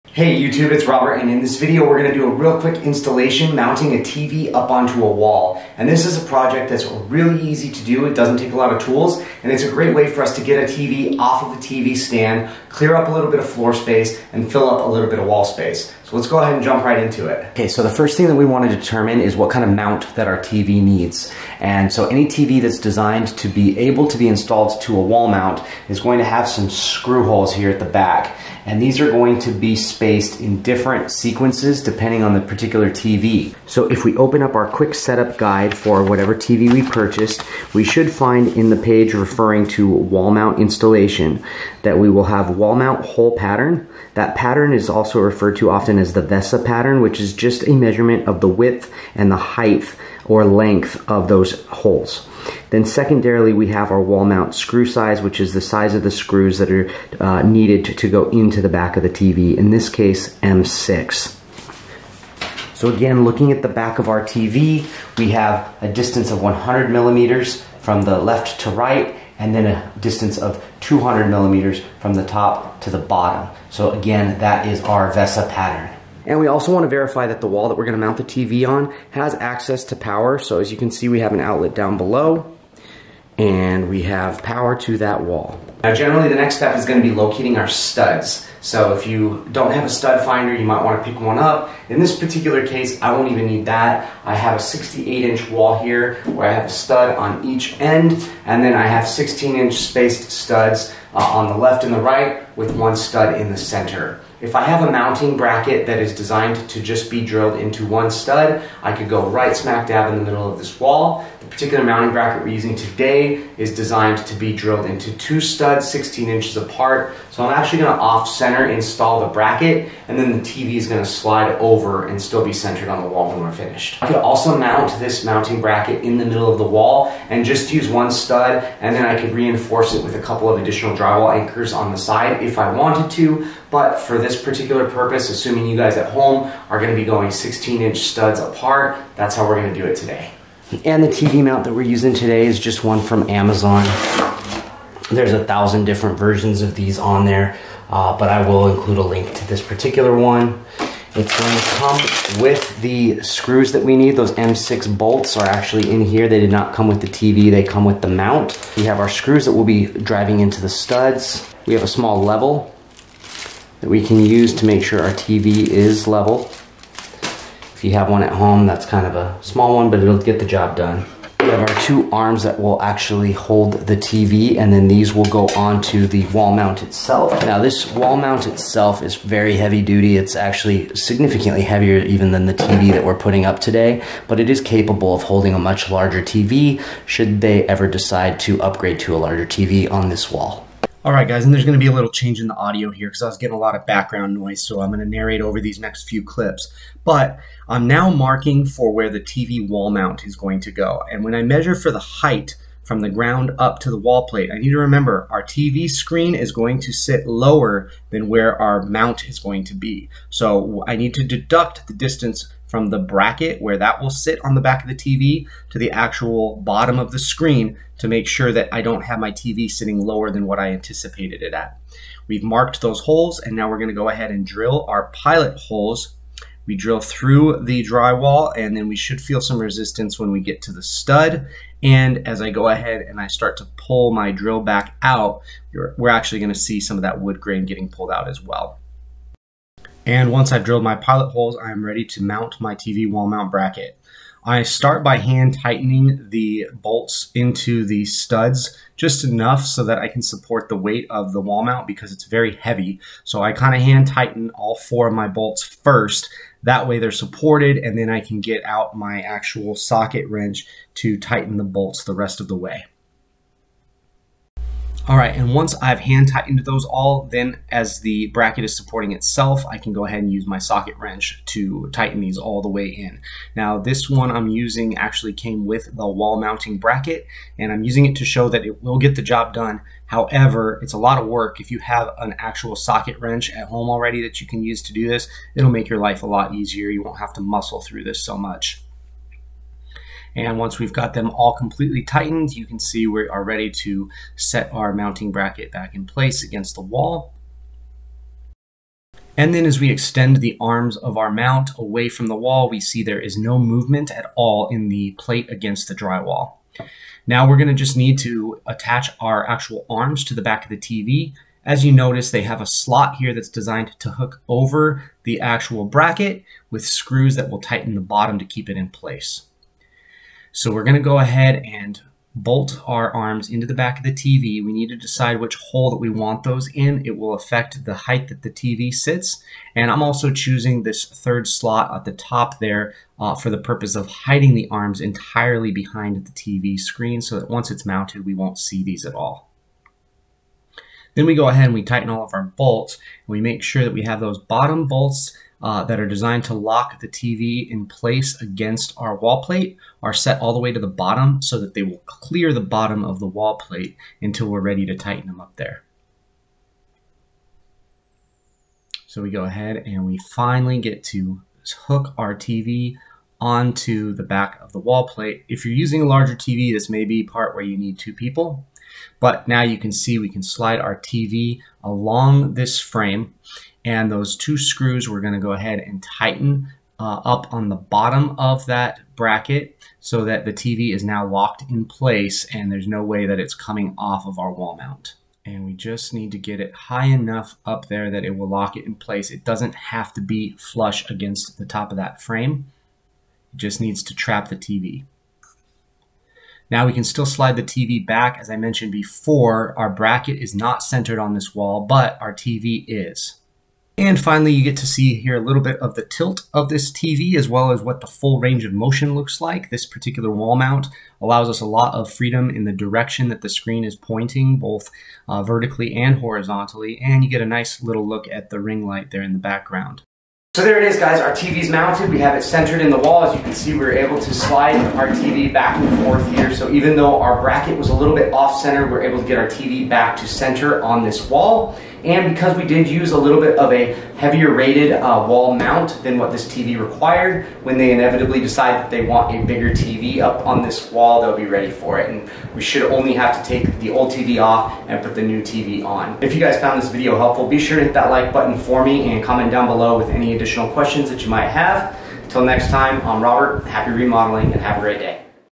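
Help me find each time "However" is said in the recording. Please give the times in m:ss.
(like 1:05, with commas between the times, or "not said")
4:40.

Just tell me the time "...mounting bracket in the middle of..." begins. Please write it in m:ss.
2:05.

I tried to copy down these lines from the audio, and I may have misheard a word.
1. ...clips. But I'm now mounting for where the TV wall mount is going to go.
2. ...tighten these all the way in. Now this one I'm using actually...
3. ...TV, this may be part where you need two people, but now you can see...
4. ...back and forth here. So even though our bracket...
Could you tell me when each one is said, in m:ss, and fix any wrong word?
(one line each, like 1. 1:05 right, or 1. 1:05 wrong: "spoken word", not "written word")
1. 3:16 wrong: "marking", not "mounting"
2. 4:31 right
3. 6:06 right
4. 7:05 right.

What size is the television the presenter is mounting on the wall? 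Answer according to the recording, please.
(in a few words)
68 inch.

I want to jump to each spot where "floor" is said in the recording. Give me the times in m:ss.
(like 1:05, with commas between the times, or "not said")
0:13.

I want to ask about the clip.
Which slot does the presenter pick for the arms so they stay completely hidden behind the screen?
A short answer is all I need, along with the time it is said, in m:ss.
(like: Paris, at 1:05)
Third slot, at 5:31.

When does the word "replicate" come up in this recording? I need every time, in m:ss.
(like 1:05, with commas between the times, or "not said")
not said.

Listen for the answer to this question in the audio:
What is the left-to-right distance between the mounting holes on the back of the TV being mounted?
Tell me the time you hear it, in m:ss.
1:06.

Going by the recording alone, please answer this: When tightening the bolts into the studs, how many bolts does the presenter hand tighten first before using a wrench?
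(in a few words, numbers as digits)
4.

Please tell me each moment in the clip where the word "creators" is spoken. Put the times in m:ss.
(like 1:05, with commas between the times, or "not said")
not said.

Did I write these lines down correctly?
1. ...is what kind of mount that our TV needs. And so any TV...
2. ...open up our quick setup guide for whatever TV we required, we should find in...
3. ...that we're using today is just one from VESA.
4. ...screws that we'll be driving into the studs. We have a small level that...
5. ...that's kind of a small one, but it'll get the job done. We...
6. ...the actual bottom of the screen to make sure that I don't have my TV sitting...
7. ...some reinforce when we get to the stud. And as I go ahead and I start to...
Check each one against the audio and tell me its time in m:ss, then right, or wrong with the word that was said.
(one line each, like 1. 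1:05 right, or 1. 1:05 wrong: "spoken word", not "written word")
1. 0:19 right
2. 0:34 wrong: "purchased", not "required"
3. 2:21 wrong: "Amazon", not "VESA"
4. 2:39 right
5. 2:48 right
6. 3:35 right
7. 3:49 wrong: "resistance", not "reinforce".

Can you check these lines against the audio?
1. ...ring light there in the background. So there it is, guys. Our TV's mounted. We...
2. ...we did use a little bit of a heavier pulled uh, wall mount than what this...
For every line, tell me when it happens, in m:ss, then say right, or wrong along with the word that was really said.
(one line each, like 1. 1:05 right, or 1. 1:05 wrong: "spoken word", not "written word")
1. 6:58 right
2. 7:12 wrong: "rated", not "pulled".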